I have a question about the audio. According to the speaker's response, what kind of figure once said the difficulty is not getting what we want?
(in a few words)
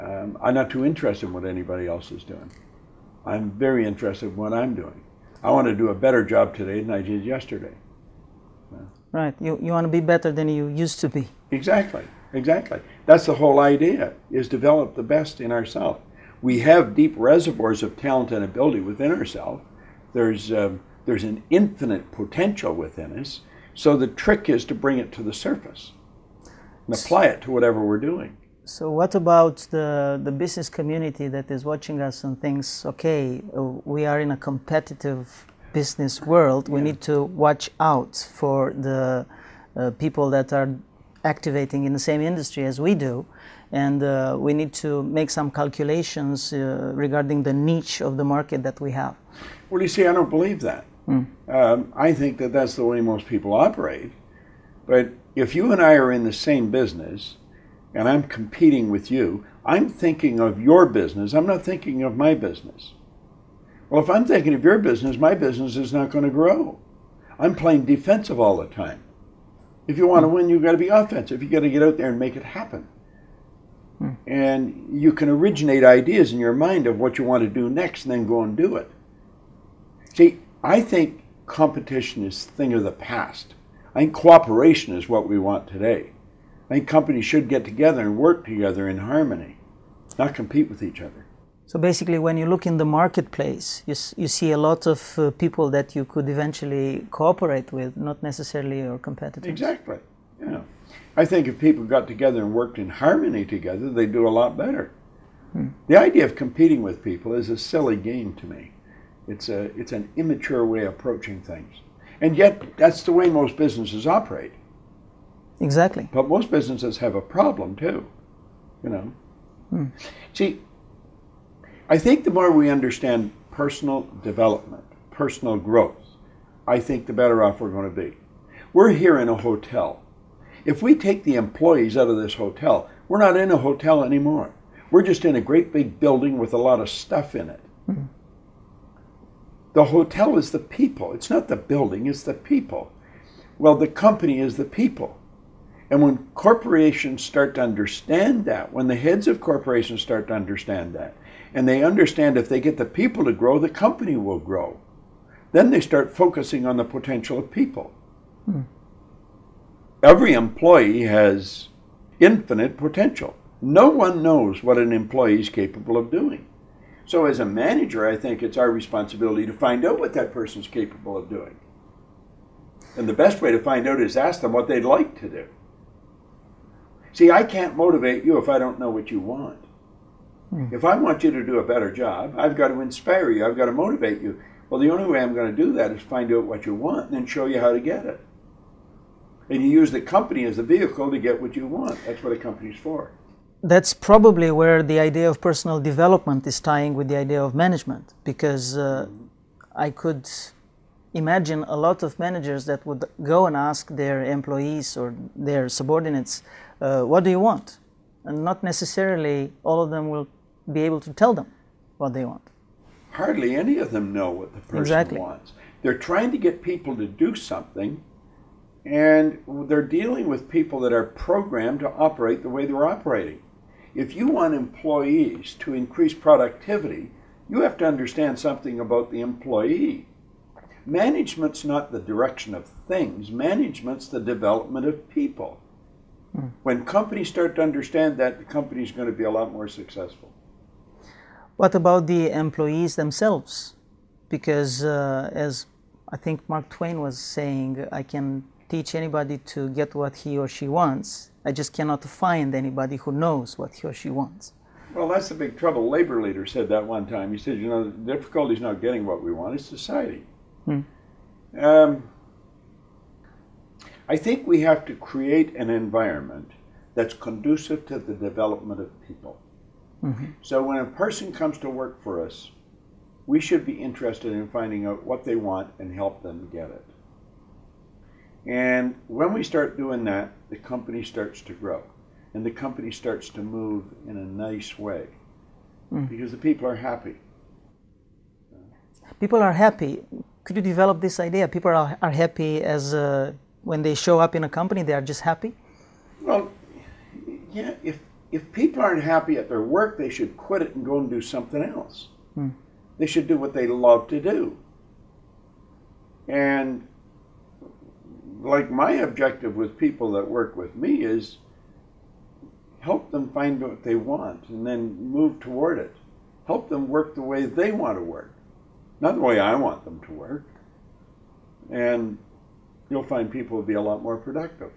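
labor leader.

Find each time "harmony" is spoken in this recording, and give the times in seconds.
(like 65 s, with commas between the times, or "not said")
88 s, 102 s.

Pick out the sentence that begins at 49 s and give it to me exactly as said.
Well, you see, I don't believe that.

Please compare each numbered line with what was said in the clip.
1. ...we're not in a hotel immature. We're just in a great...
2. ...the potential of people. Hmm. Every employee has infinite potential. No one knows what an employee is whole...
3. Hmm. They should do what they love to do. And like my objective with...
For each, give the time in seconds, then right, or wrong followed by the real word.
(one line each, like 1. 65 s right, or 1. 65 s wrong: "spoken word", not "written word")
1. 133 s wrong: "anymore", not "immature"
2. 156 s wrong: "capable", not "whole"
3. 302 s right.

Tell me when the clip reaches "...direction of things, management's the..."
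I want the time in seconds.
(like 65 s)
231 s.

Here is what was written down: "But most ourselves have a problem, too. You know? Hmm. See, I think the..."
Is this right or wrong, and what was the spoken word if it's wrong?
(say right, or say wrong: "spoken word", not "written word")
wrong: "businesses", not "ourselves".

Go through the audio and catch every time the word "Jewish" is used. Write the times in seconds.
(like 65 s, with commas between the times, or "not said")
not said.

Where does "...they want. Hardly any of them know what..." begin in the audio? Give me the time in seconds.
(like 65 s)
212 s.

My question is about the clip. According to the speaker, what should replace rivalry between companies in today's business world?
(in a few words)
cooperation.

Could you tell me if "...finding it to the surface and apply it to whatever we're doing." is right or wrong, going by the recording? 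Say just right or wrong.
wrong.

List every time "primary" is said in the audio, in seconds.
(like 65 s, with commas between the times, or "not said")
not said.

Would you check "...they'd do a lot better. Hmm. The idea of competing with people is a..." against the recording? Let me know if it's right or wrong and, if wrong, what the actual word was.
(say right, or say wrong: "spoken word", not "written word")
right.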